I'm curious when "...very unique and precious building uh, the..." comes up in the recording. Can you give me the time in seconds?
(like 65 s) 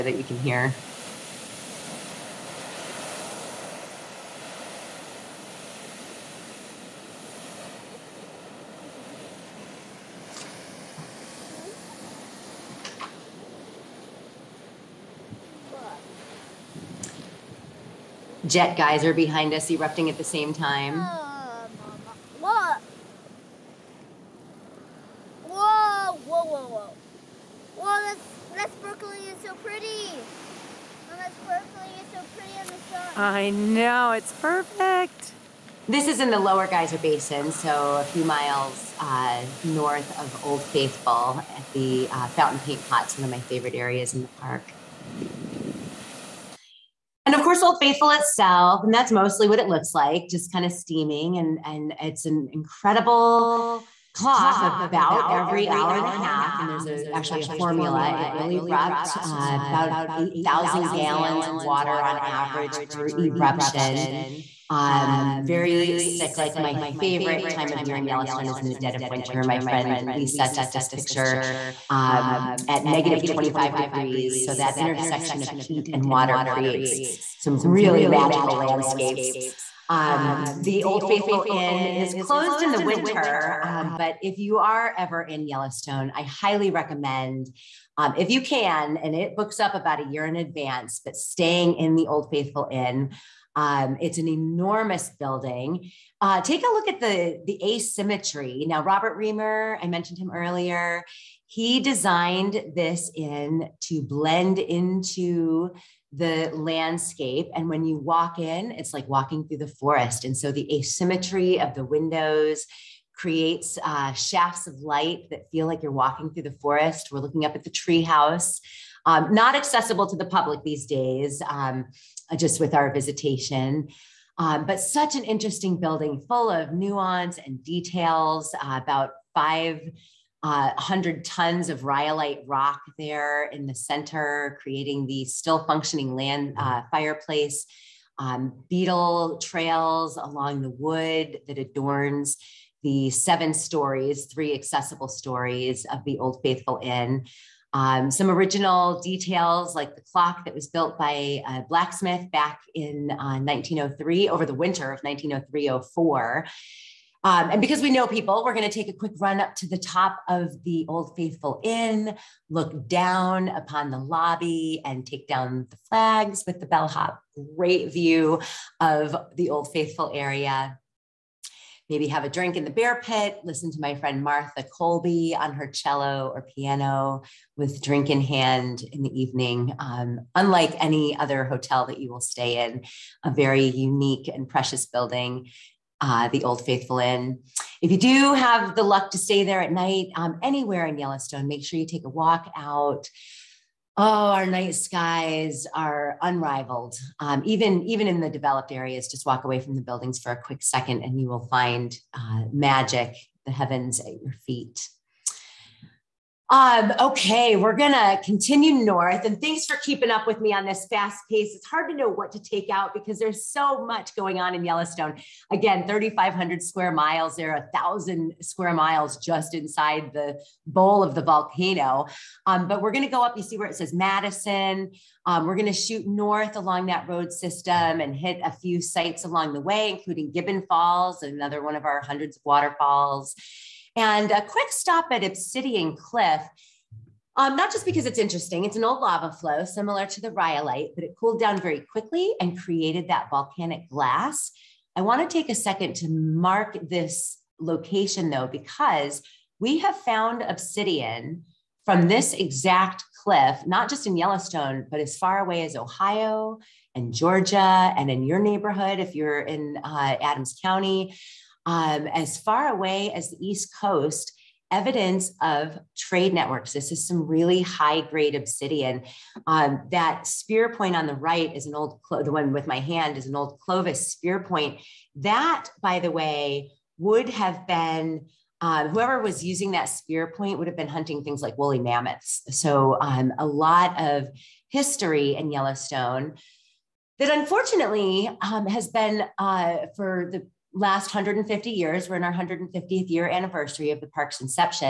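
183 s.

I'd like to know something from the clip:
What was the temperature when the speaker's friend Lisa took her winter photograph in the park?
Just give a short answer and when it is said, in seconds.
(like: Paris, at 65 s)
-25 degrees, at 72 s.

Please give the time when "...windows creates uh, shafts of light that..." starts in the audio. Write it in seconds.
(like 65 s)
111 s.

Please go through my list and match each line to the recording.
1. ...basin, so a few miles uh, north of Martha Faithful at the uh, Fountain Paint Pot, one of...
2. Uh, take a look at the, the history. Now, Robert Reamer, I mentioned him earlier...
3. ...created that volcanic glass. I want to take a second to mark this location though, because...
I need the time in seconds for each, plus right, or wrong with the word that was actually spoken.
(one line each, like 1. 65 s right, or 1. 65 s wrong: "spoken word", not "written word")
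1. 36 s wrong: "Old", not "Martha"
2. 96 s wrong: "asymmetry", not "history"
3. 242 s right.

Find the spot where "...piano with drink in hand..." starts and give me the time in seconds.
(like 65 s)
176 s.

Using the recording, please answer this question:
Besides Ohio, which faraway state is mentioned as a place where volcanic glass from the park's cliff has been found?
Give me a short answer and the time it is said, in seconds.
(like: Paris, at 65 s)
Georgia, at 257 s.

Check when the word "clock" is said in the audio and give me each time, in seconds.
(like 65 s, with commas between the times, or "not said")
54 s, 150 s.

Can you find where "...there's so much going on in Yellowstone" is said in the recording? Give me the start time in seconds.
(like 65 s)
213 s.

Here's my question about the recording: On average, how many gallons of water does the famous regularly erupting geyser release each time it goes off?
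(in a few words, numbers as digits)
8,000 gallons.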